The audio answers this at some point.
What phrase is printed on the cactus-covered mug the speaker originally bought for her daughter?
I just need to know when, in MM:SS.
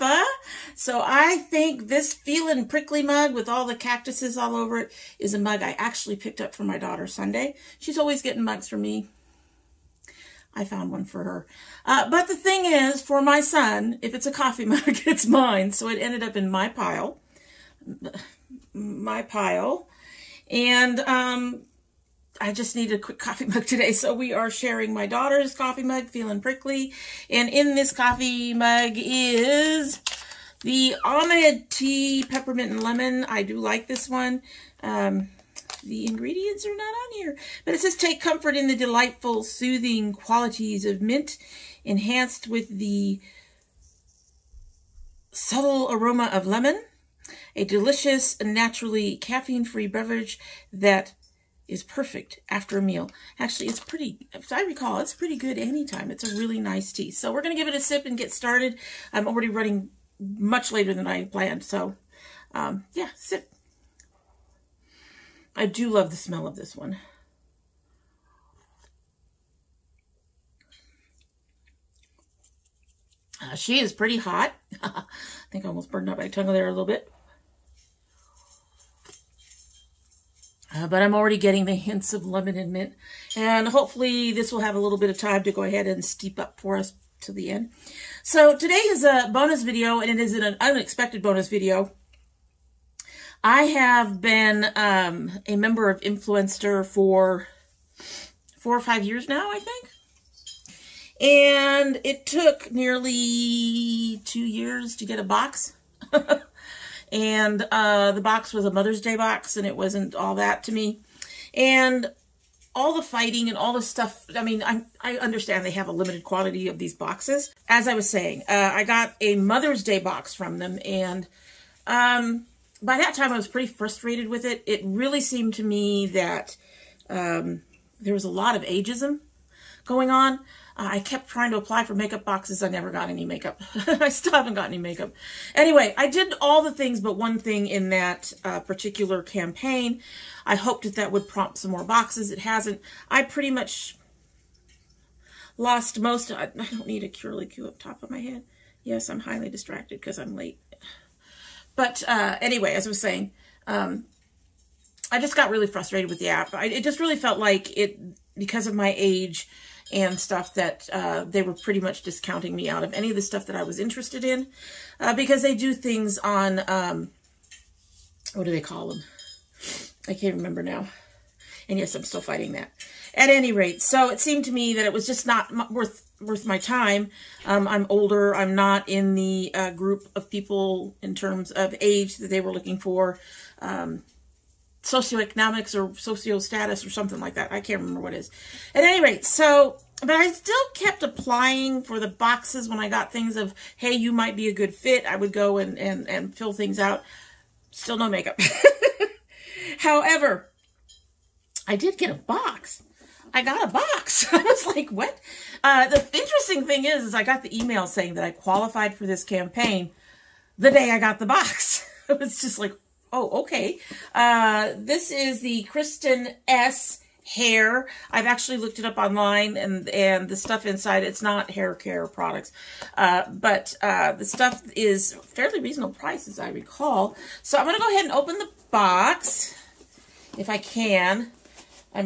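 00:02.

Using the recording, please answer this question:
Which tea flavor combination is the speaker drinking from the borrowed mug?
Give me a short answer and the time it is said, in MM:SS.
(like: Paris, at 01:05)
Peppermint and Lemon, at 00:32.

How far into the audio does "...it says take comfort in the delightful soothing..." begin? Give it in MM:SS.
00:37.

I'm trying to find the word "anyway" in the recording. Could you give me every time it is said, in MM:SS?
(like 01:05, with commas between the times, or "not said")
02:15, 02:32.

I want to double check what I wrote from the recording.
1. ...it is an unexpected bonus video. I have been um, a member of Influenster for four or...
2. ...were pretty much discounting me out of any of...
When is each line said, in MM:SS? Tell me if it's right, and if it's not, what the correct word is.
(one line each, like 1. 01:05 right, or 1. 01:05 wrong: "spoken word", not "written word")
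1. 01:30 right
2. 02:41 right.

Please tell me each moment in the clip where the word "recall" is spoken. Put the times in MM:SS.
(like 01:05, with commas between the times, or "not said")
00:54, 03:46.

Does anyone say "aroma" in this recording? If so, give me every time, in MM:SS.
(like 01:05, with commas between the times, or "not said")
00:45.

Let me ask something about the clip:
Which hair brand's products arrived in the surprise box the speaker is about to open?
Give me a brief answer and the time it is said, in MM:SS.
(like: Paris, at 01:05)
Kristin Ess, at 03:35.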